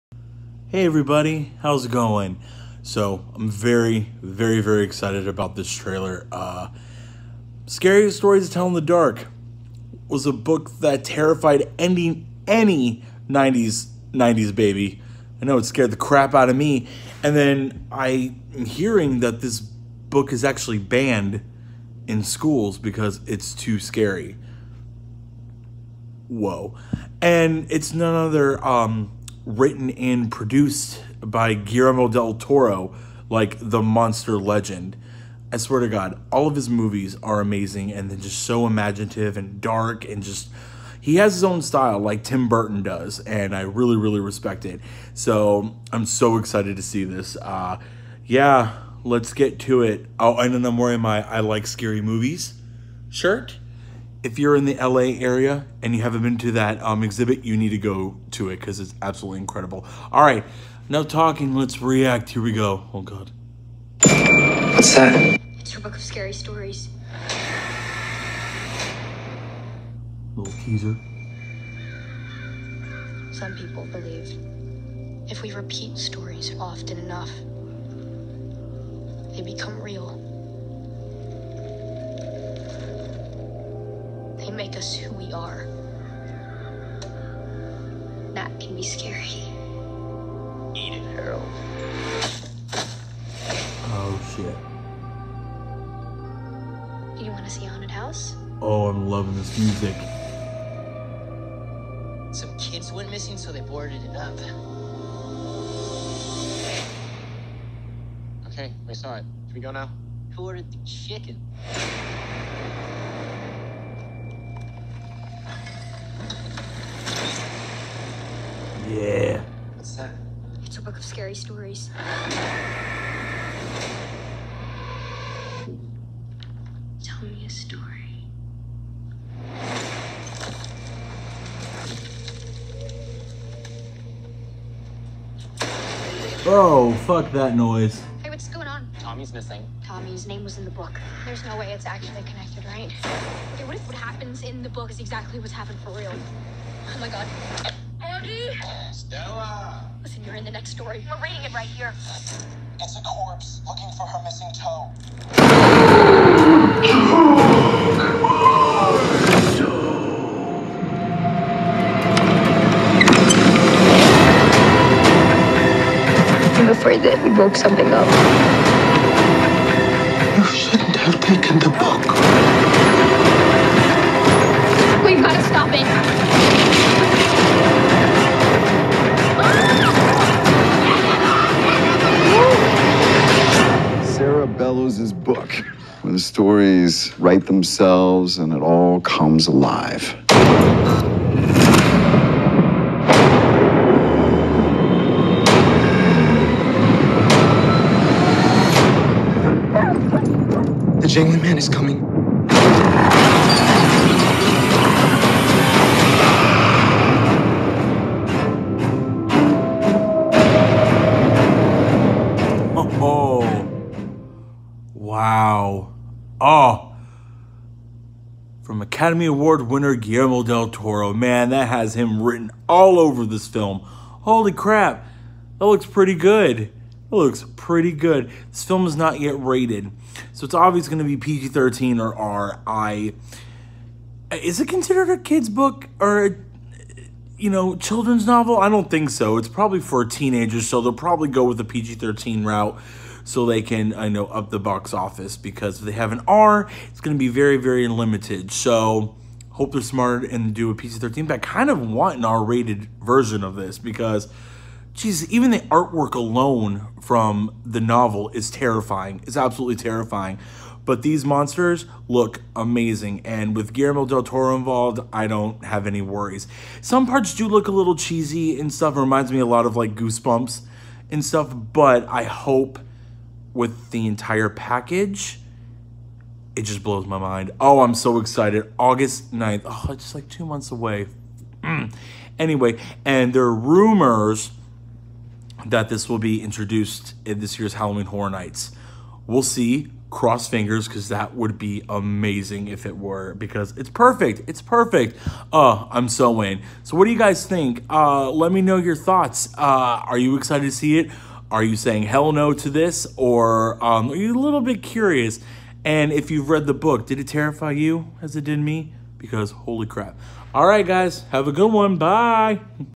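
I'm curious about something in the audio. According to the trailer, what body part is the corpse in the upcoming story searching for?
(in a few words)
toe.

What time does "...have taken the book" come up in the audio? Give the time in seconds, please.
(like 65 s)
170 s.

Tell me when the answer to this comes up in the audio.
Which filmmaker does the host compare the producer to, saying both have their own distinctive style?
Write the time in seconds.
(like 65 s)
42 s.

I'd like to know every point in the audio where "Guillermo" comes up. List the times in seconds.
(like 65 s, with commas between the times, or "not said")
31 s, 219 s, 263 s.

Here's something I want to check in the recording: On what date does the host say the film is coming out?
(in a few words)
August 9.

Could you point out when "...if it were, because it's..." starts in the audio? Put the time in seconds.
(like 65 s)
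292 s.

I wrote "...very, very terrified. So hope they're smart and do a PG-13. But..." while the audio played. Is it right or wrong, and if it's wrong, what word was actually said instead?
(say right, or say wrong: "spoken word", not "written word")
wrong: "limited", not "terrified".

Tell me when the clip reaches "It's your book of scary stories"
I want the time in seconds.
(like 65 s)
65 s.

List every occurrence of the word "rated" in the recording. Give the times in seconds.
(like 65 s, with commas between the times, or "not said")
229 s, 252 s.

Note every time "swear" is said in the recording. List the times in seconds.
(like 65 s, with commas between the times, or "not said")
35 s.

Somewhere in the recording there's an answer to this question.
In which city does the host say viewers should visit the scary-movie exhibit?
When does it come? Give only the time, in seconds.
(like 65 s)
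54 s.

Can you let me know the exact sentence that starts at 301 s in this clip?
Are you saying hell no to this?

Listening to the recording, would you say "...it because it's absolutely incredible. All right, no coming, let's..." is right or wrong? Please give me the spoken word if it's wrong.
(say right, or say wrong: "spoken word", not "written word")
wrong: "talking", not "coming".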